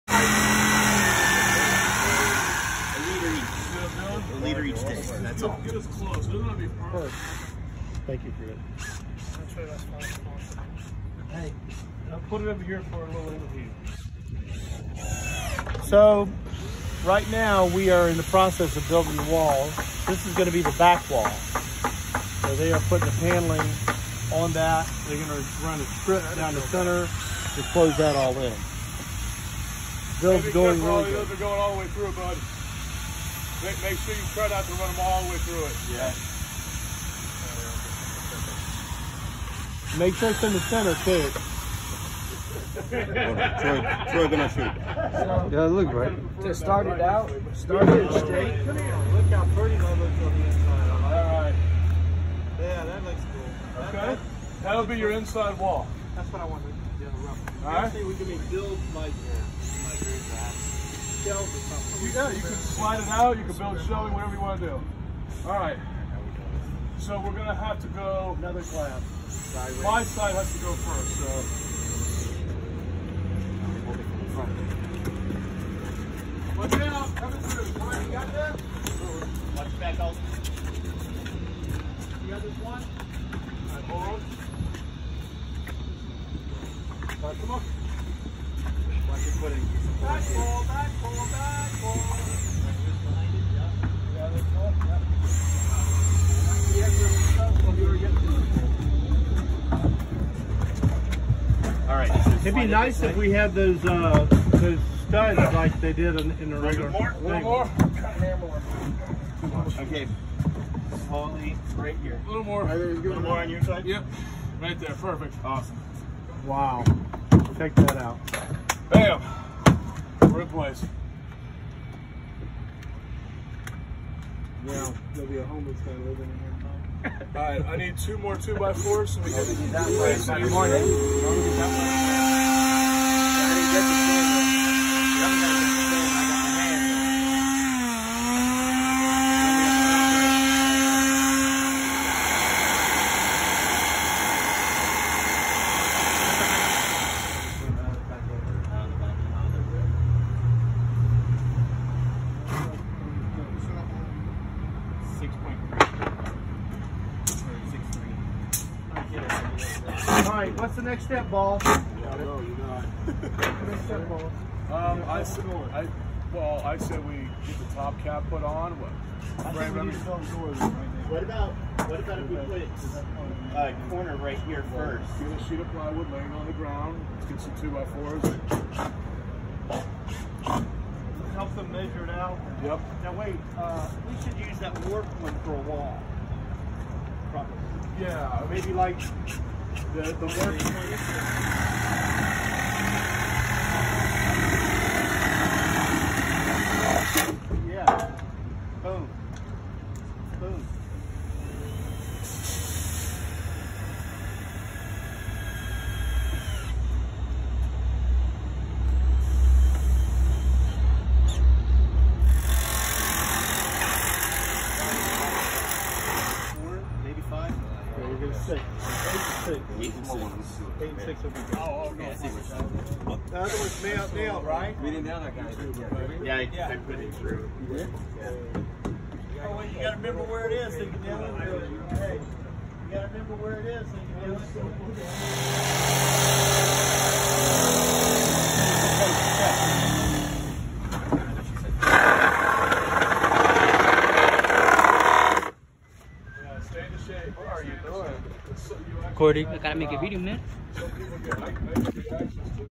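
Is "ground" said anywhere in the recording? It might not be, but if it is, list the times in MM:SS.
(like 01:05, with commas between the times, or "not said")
02:56.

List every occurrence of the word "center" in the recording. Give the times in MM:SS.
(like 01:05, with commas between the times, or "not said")
00:26, 00:40.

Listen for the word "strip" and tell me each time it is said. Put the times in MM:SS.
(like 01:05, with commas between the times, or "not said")
00:25.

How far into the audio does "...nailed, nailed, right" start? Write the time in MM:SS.
03:43.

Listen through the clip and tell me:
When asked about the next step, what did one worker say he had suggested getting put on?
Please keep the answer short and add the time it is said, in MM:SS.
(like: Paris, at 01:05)
The top cap, at 02:47.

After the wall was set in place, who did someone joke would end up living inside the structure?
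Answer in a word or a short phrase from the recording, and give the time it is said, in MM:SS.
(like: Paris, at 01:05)
A homeless guy, at 02:05.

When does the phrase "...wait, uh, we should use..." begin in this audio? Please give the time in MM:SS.
03:03.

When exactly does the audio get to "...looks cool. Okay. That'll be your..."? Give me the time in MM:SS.
00:53.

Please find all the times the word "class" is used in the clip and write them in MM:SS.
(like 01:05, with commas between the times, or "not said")
01:08.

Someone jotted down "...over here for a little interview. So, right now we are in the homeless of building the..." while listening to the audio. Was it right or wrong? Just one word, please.
wrong.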